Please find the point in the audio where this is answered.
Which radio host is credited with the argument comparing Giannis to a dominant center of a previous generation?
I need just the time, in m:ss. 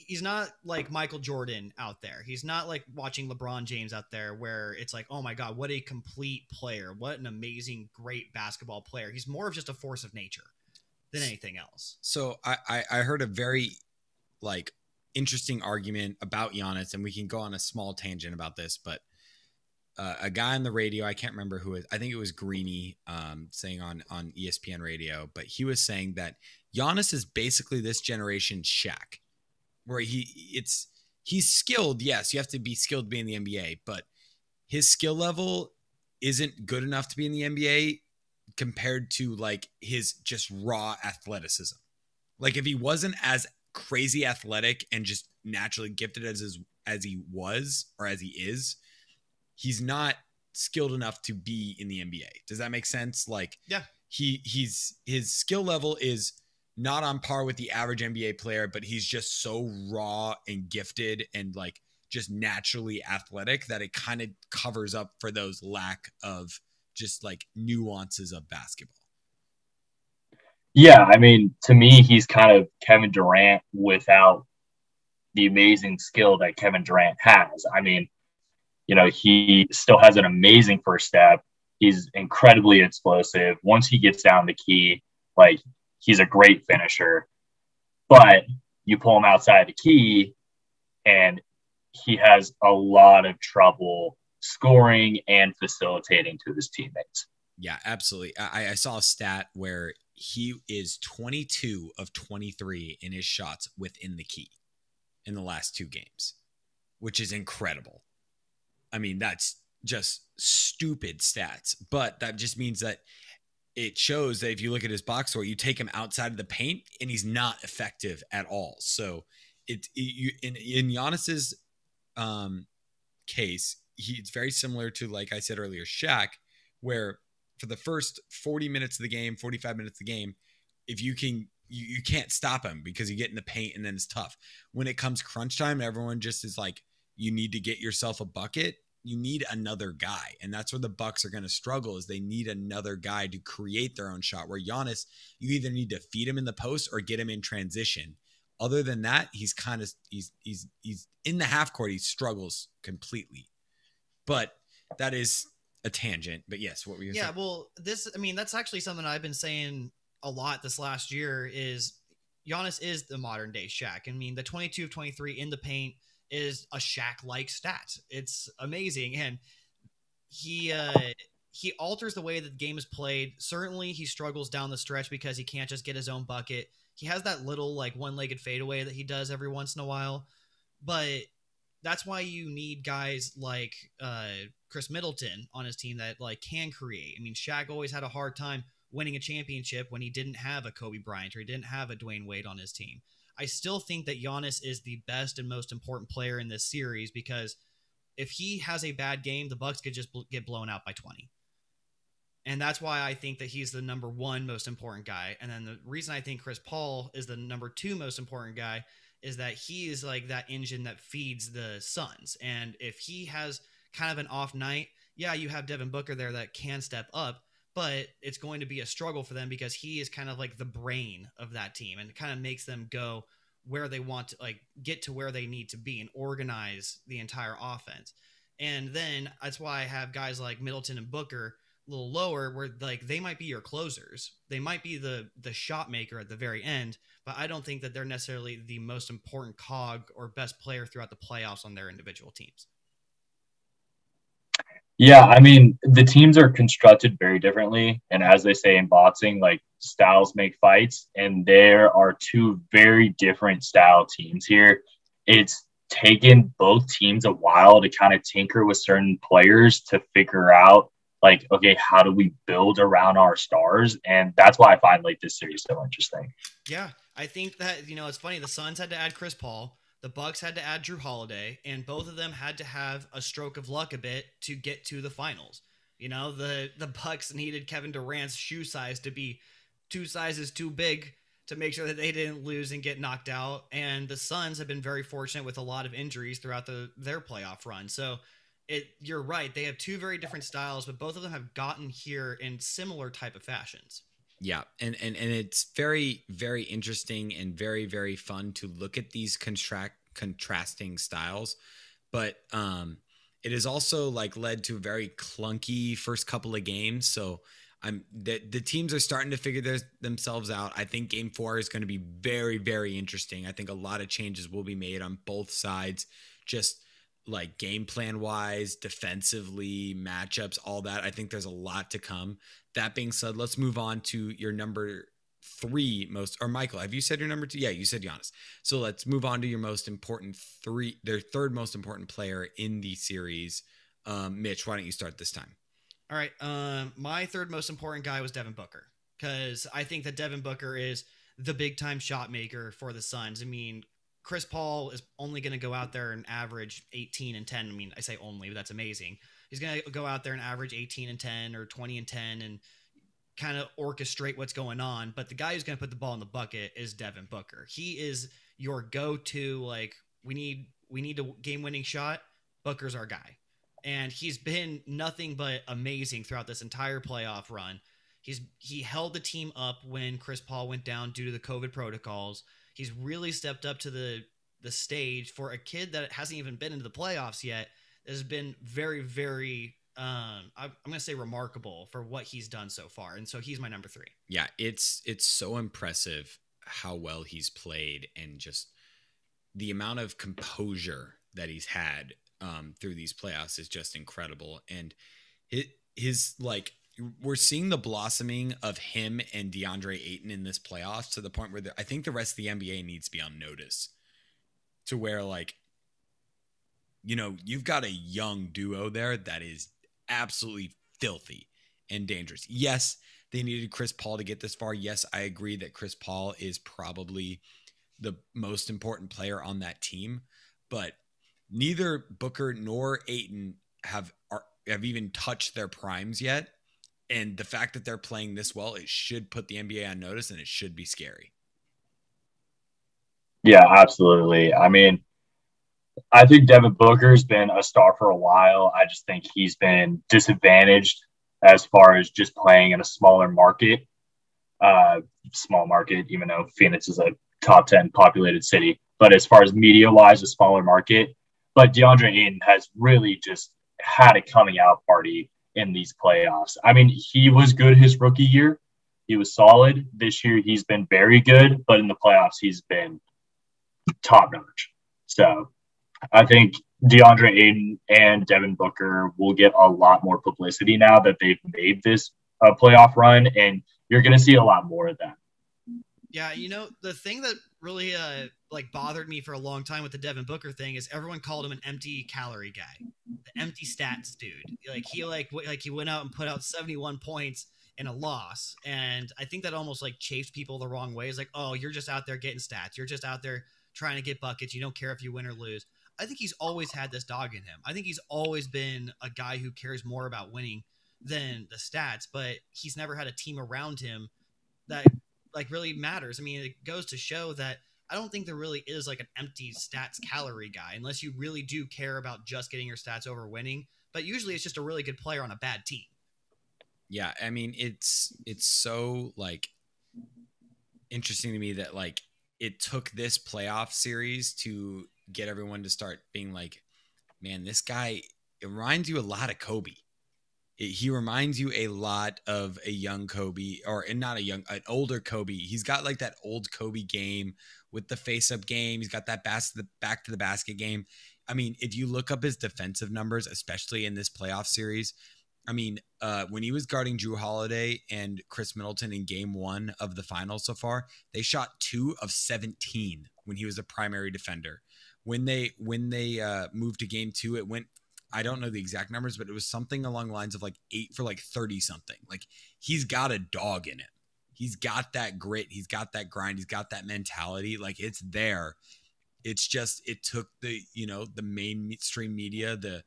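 0:22.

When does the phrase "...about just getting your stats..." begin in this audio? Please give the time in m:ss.
8:31.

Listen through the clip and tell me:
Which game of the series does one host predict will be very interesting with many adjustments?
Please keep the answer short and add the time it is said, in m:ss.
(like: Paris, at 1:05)
game four, at 5:11.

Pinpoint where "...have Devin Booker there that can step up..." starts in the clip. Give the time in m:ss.
3:35.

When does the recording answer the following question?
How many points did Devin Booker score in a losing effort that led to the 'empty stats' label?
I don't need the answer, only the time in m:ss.
8:06.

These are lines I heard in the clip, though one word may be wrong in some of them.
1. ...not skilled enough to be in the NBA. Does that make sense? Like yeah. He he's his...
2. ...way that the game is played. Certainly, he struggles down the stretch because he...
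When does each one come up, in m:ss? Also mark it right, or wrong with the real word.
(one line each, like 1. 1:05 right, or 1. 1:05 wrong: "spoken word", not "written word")
1. 0:49 right
2. 2:52 right.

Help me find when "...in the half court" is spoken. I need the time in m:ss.
2:31.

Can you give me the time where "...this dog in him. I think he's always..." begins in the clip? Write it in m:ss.
8:16.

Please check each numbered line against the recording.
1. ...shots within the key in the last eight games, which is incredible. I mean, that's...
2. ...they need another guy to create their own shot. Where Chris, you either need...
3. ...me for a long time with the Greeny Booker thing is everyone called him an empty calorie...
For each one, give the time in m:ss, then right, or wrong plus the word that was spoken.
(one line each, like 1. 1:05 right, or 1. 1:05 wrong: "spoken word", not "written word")
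1. 1:43 wrong: "two", not "eight"
2. 2:22 wrong: "Giannis", not "Chris"
3. 7:59 wrong: "Devin", not "Greeny".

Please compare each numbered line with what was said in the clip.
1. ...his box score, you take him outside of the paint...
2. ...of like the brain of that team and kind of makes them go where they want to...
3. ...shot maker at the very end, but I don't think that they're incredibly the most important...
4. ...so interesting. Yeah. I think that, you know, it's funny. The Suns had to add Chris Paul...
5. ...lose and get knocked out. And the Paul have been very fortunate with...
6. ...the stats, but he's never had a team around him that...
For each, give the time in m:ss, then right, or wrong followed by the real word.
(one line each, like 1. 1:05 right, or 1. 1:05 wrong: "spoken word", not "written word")
1. 1:54 right
2. 3:40 right
3. 3:55 wrong: "necessarily", not "incredibly"
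4. 4:25 right
5. 4:42 wrong: "Suns", not "Paul"
6. 8:21 right.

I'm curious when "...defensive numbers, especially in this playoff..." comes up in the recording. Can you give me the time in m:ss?
9:02.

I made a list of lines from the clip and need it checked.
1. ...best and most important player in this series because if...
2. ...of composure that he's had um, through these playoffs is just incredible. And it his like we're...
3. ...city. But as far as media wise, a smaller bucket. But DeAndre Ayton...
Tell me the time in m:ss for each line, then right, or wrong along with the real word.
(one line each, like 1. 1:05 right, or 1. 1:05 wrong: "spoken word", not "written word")
1. 3:15 right
2. 6:29 right
3. 7:28 wrong: "market", not "bucket".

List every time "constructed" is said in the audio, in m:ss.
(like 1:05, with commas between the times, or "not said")
4:06.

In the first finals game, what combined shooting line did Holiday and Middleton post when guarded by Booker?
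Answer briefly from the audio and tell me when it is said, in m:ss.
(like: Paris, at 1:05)
2 of 17, at 9:11.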